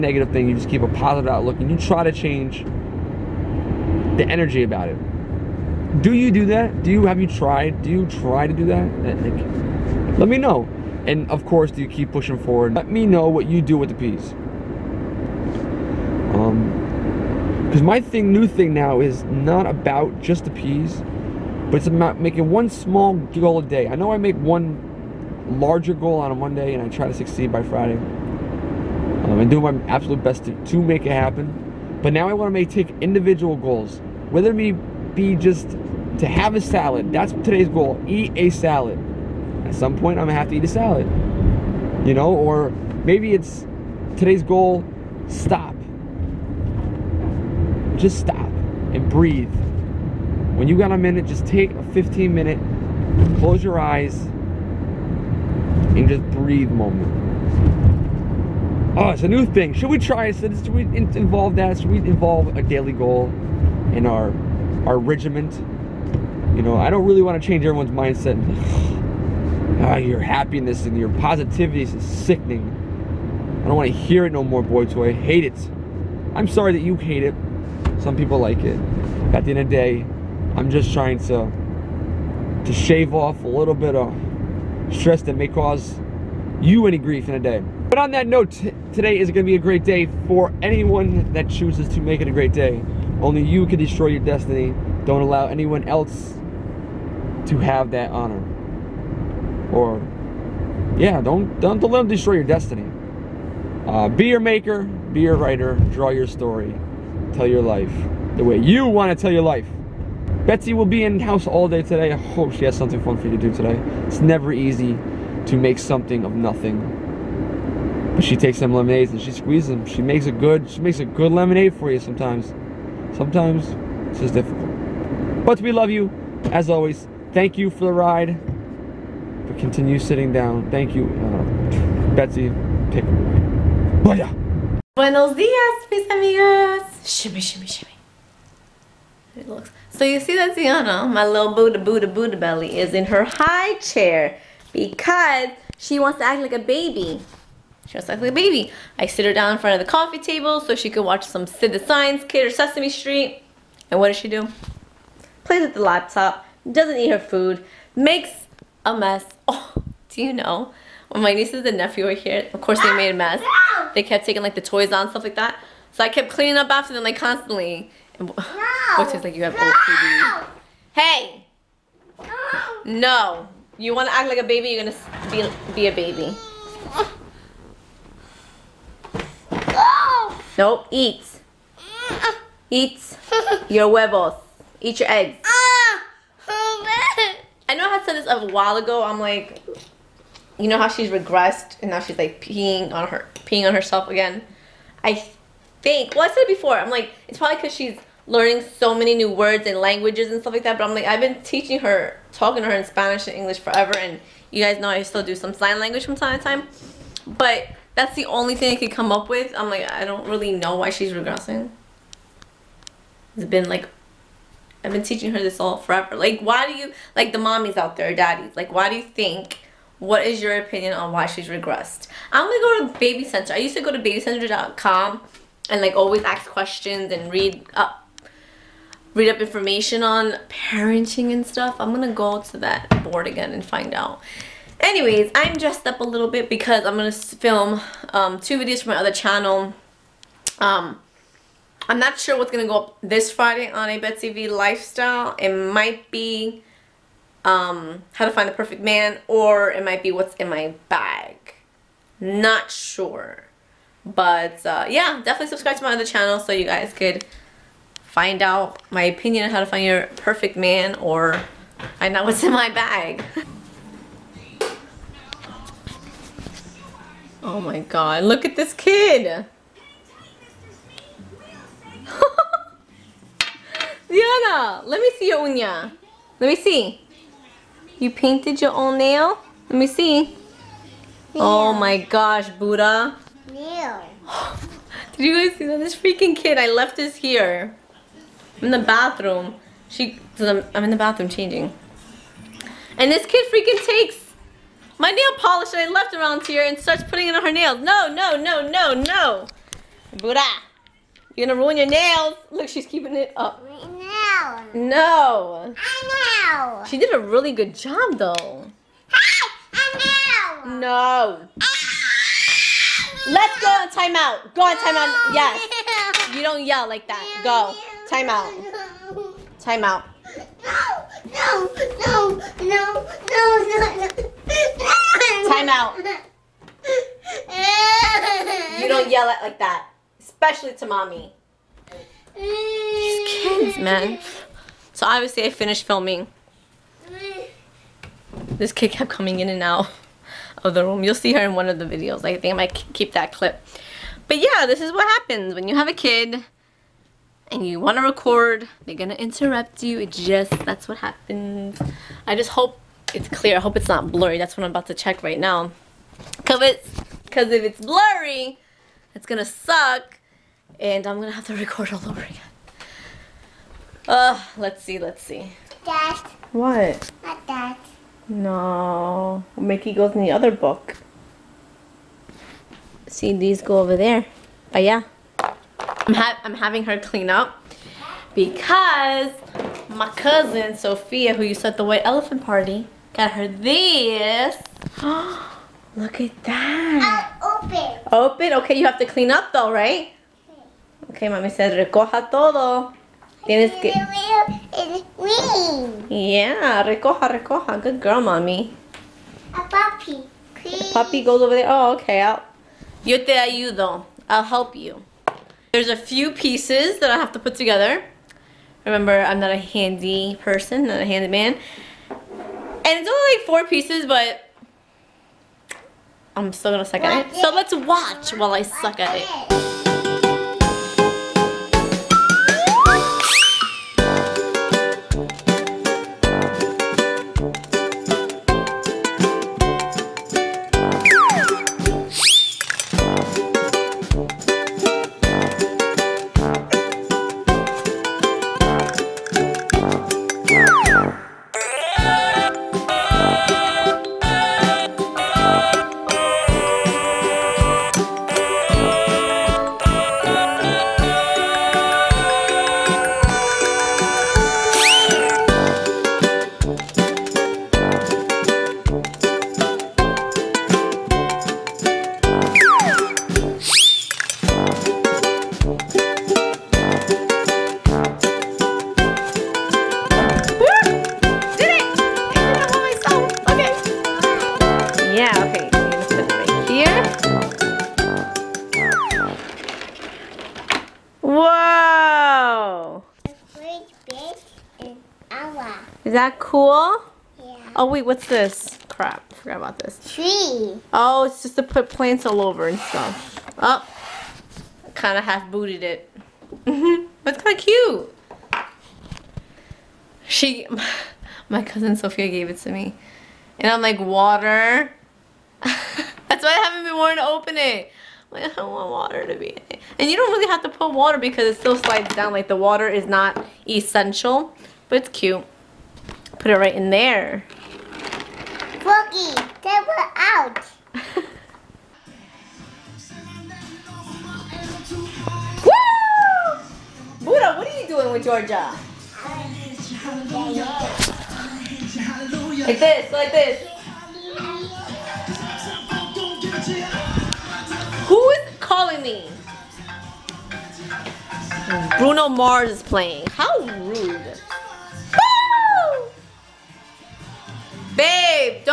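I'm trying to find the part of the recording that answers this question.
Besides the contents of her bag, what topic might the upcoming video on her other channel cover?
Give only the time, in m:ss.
4:08.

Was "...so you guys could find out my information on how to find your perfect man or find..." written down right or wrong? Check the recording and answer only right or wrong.
wrong.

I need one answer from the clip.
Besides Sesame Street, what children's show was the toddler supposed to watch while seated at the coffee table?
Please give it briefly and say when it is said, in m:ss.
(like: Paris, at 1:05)
Sid the Science Kid, at 2:31.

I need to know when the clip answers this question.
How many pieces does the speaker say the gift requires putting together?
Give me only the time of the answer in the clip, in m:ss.
6:53.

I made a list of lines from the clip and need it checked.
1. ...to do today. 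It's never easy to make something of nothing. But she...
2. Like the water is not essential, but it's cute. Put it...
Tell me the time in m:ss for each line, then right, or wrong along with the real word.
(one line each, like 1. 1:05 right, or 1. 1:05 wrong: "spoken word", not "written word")
1. 1:53 right
2. 8:32 right.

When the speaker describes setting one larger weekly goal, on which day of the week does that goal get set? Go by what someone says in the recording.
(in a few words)
Monday.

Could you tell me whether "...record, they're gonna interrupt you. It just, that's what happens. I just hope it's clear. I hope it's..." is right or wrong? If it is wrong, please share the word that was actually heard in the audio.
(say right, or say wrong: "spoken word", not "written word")
right.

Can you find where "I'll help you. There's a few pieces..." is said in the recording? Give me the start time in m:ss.
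6:44.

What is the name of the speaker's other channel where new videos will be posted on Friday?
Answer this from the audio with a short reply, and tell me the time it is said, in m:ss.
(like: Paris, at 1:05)
Betsy V lifestyle, at 4:03.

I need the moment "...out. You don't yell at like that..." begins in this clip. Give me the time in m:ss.
5:25.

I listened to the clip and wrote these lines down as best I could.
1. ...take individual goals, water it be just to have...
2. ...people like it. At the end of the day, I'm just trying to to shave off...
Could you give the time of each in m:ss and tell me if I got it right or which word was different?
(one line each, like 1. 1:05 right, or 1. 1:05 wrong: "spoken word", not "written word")
1. 0:32 wrong: "whether", not "water"
2. 1:18 right.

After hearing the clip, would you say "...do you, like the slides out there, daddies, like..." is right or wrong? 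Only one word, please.
wrong.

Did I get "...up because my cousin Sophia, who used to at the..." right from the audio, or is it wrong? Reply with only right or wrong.
right.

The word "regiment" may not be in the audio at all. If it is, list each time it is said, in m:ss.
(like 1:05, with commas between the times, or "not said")
1:04.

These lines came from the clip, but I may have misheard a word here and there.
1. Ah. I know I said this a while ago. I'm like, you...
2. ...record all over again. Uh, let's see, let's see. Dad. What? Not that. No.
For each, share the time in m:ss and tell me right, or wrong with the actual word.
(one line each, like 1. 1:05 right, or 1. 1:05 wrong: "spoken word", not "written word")
1. 3:05 right
2. 6:01 right.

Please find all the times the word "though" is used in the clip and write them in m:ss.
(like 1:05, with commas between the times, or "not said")
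5:08, 6:29.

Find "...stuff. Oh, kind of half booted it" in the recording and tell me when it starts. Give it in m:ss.
8:12.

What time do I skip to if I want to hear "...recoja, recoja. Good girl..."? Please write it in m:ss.
6:36.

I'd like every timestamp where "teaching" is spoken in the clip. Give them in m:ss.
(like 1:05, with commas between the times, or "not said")
3:21, 3:35.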